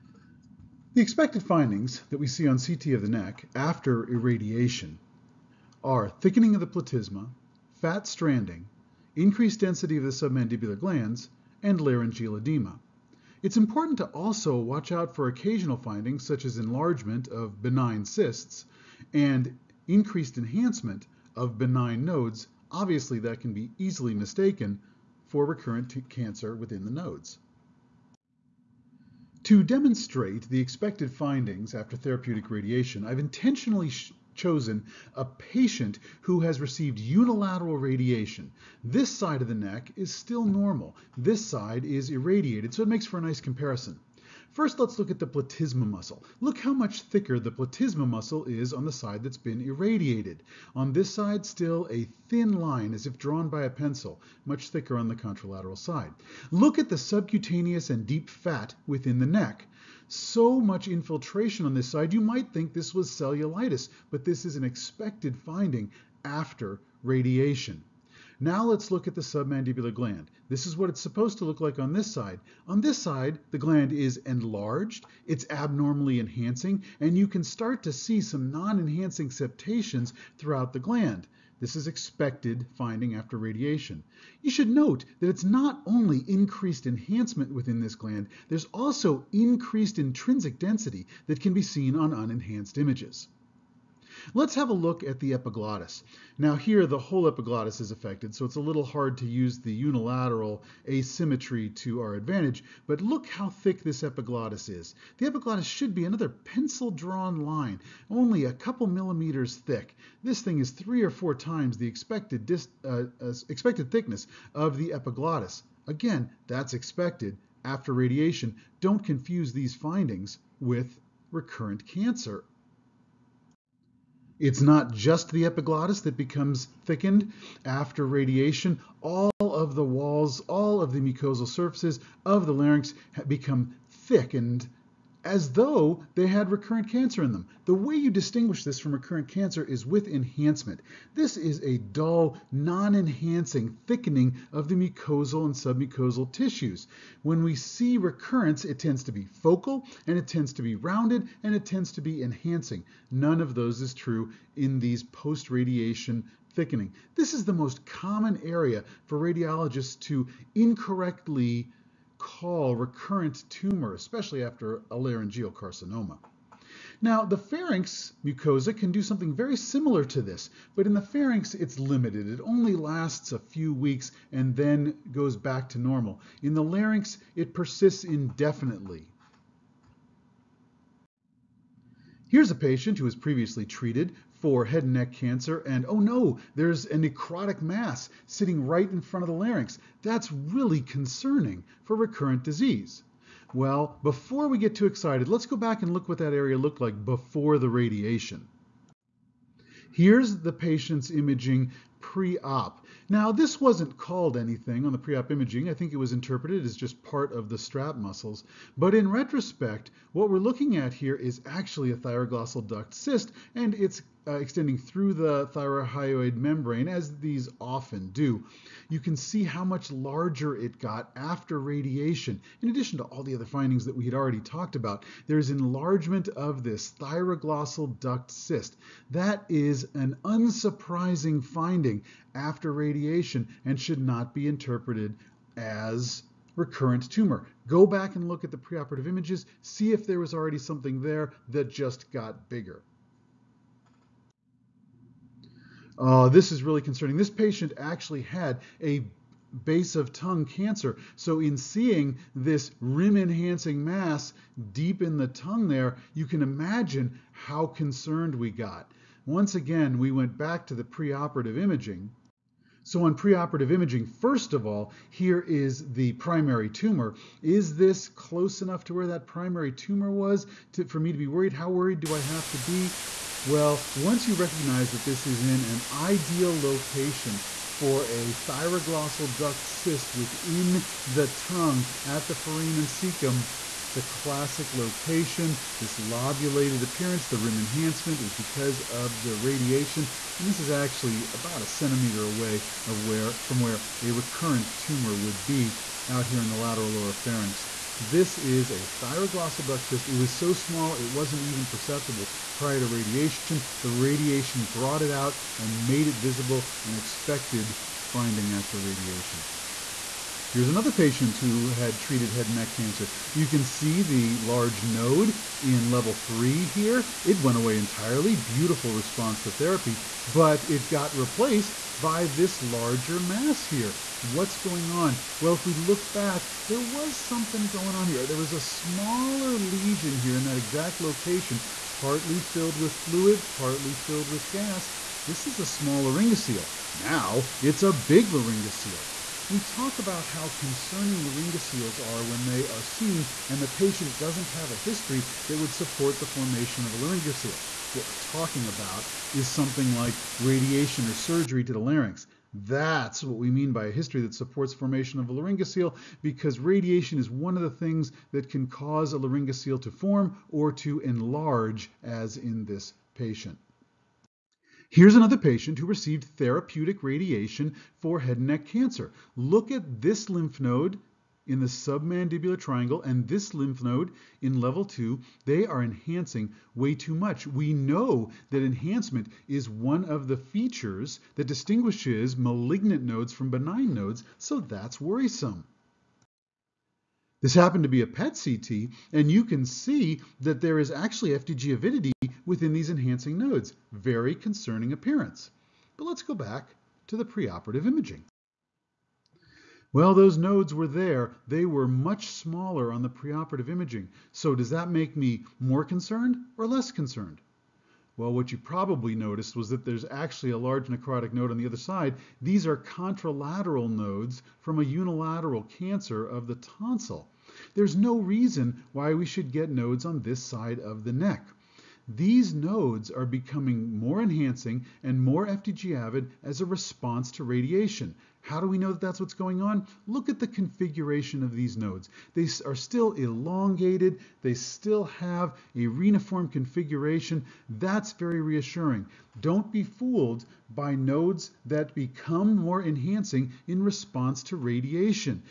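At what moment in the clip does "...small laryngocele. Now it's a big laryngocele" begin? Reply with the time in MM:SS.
05:35.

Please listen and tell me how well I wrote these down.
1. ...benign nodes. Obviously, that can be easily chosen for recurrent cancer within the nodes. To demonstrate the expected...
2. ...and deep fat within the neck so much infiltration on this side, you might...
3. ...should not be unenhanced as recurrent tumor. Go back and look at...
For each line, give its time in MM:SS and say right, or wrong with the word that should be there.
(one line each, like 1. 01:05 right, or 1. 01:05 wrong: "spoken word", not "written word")
1. 00:21 wrong: "mistaken", not "chosen"
2. 00:57 right
3. 03:53 wrong: "interpreted", not "unenhanced".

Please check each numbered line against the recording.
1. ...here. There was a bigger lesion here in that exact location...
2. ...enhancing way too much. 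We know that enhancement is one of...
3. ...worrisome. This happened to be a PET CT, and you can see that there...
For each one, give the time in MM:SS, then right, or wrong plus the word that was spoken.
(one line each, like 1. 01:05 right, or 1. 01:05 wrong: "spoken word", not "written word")
1. 05:28 wrong: "smaller", not "bigger"
2. 06:15 right
3. 06:24 right.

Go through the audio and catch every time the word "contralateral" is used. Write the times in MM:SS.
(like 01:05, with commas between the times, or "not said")
00:55, 06:52.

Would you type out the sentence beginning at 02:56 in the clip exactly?
In the larynx, it persists indefinitely.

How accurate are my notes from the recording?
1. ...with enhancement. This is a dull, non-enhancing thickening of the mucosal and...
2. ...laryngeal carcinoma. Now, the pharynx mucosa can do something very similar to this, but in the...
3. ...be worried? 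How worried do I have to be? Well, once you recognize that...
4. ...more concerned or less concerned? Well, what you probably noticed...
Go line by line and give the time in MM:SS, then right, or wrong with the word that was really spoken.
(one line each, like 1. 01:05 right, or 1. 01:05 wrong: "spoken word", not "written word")
1. 02:19 right
2. 02:44 right
3. 04:31 right
4. 06:45 right.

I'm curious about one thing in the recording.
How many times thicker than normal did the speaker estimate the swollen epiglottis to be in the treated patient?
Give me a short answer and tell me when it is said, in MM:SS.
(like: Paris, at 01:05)
3 or 4, at 01:50.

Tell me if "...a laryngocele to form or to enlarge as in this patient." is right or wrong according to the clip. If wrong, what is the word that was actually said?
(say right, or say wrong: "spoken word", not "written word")
right.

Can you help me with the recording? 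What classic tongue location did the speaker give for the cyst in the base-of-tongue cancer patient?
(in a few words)
foramen cecum.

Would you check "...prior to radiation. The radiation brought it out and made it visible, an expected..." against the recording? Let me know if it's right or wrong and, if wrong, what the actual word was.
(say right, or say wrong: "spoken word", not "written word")
right.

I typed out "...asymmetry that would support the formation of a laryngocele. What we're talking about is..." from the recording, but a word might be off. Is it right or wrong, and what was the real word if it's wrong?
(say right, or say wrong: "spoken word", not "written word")
wrong: "history", not "asymmetry".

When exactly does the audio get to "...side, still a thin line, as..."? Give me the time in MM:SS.
00:51.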